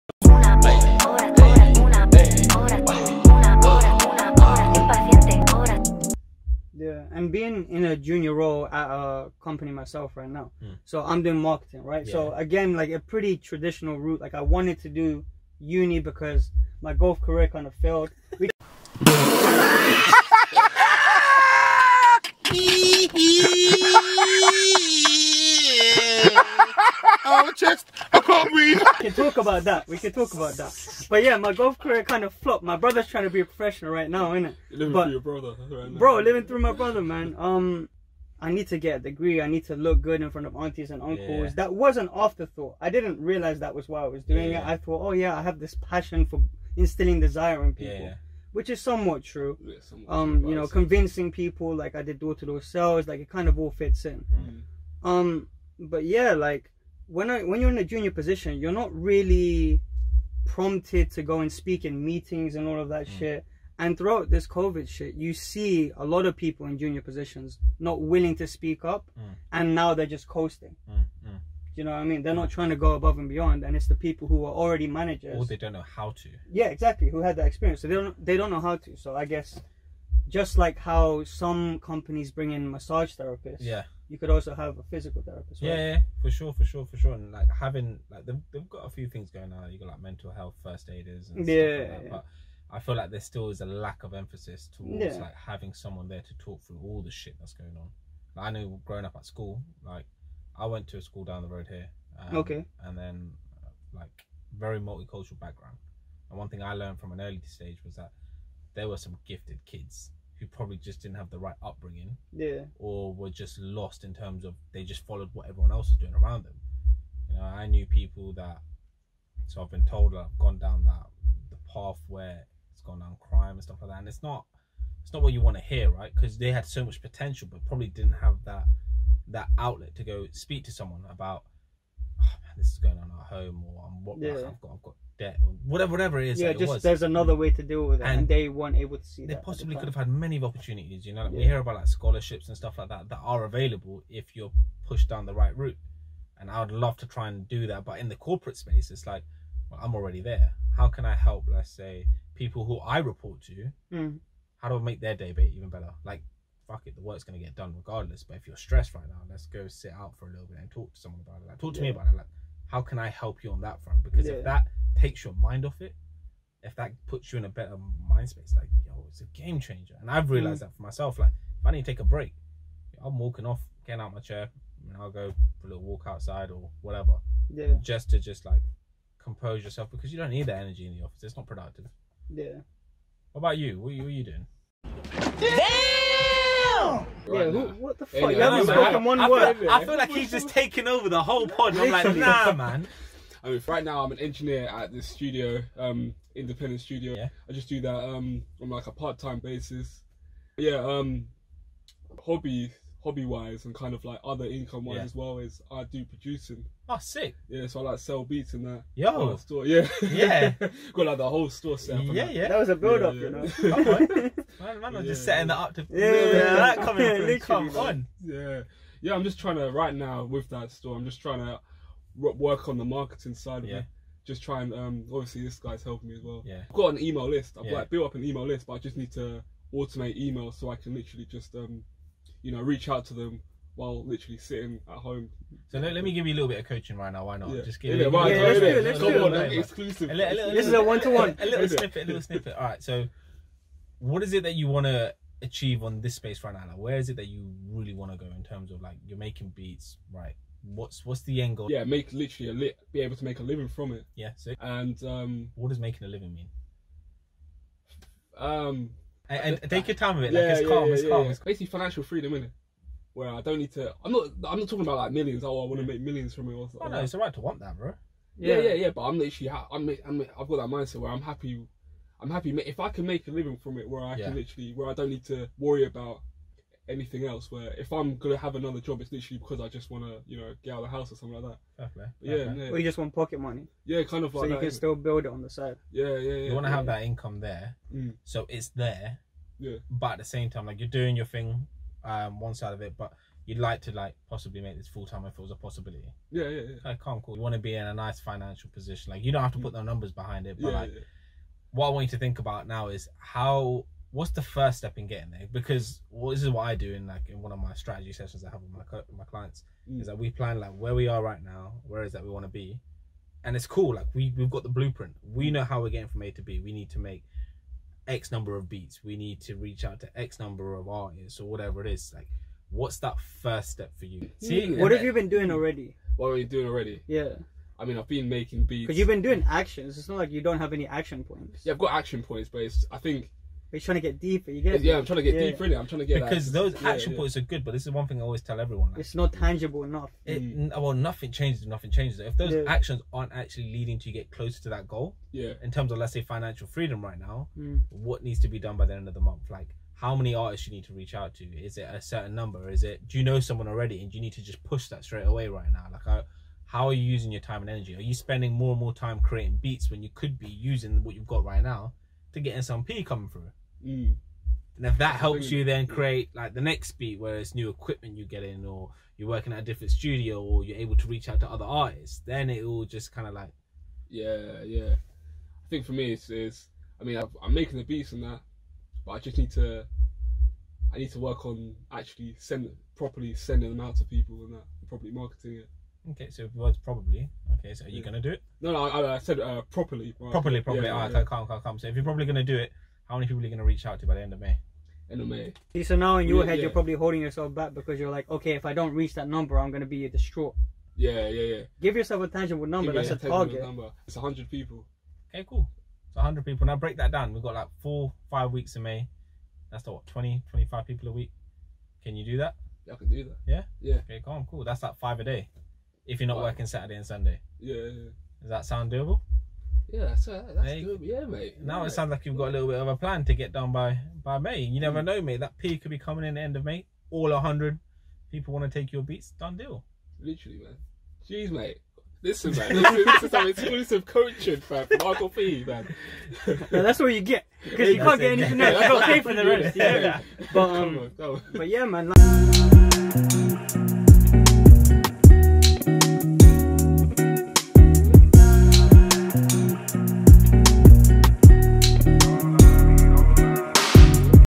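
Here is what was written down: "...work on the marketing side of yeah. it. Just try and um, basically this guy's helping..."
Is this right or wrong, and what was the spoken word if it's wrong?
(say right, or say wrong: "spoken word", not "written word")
wrong: "obviously", not "basically".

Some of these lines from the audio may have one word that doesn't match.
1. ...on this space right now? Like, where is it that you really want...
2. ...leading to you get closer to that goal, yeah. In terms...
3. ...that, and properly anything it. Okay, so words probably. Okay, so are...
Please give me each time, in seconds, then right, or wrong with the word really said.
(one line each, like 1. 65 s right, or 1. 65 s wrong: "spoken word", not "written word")
1. 245 s right
2. 343 s right
3. 384 s wrong: "marketing", not "anything".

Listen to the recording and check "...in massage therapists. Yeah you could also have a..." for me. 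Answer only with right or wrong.
right.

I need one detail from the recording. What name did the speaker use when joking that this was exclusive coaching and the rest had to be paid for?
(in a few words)
Michael P.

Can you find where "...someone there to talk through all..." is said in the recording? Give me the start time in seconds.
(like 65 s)
95 s.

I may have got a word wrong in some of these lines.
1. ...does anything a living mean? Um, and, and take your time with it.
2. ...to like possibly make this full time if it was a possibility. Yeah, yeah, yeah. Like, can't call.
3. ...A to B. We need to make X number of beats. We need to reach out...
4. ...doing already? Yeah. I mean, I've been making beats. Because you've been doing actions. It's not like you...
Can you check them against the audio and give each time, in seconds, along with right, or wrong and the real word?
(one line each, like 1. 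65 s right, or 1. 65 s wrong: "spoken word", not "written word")
1. 255 s wrong: "making", not "anything"
2. 293 s right
3. 316 s right
4. 326 s right.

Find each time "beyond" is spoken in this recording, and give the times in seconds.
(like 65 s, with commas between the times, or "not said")
73 s.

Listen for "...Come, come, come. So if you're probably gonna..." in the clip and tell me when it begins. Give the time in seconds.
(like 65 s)
391 s.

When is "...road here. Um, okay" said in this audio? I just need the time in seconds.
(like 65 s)
101 s.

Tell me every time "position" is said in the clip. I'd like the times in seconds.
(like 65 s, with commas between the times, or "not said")
58 s, 67 s, 298 s.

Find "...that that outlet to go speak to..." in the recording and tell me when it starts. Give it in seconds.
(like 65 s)
128 s.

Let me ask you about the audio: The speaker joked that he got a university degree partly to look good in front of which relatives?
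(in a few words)
aunties and uncles.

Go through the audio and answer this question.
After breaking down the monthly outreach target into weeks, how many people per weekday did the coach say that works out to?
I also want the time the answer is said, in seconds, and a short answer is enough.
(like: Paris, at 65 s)
5 a day, at 414 s.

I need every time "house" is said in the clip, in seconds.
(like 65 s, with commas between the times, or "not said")
280 s.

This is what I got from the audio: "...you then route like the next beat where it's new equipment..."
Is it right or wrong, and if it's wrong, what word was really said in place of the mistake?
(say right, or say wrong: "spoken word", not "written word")
wrong: "create", not "route".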